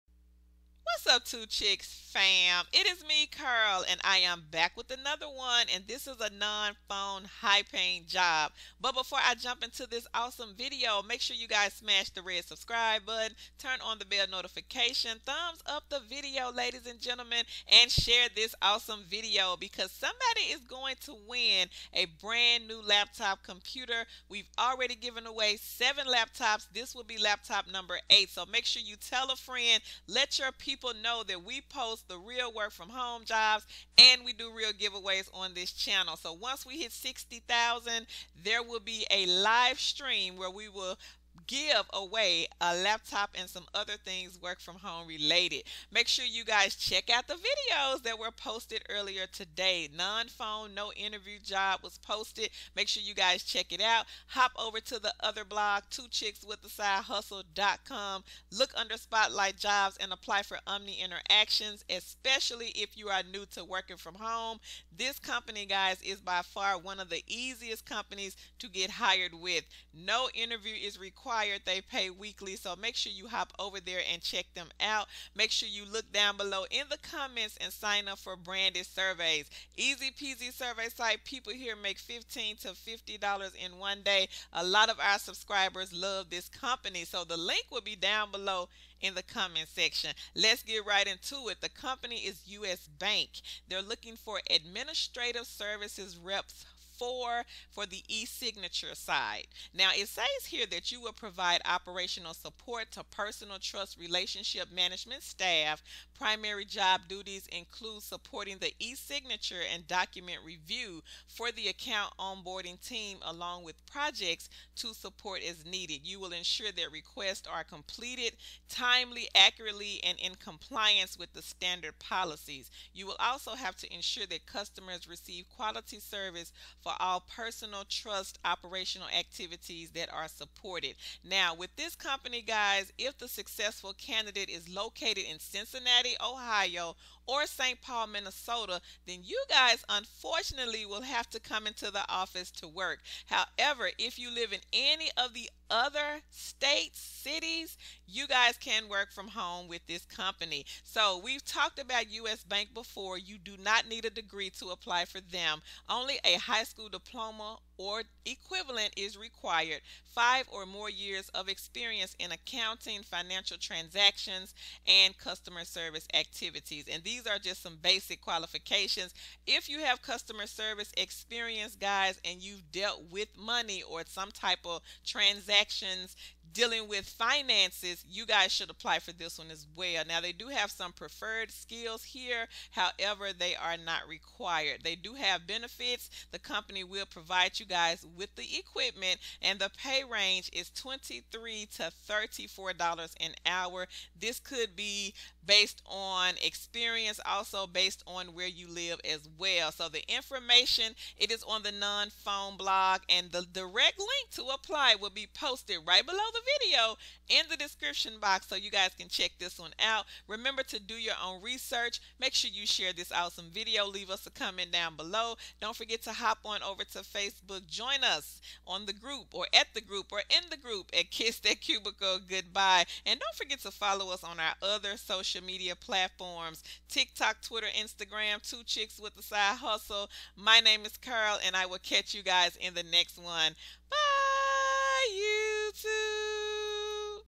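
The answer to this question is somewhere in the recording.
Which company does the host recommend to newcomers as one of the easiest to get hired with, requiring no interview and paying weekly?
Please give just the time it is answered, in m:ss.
1:00.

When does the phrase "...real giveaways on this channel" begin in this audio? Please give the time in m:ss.
0:34.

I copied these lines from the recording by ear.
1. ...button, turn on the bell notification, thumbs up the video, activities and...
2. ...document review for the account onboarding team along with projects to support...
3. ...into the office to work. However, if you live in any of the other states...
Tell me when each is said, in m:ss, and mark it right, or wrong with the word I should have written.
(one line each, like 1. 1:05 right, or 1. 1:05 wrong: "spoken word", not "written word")
1. 0:13 wrong: "ladies", not "activities"
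2. 1:49 right
3. 2:21 right.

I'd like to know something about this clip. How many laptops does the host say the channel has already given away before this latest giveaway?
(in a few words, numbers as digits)
7.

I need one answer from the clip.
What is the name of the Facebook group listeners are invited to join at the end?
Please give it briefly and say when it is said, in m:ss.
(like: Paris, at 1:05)
Kiss That Cubicle Goodbye, at 3:41.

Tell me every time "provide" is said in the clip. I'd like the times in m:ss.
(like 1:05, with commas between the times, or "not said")
1:41, 3:07.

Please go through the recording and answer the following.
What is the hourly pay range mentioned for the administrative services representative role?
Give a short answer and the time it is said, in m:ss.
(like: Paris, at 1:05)
$23 to $34 an hour, at 3:10.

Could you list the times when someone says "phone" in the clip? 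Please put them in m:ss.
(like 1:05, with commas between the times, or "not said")
0:06, 0:50, 3:21.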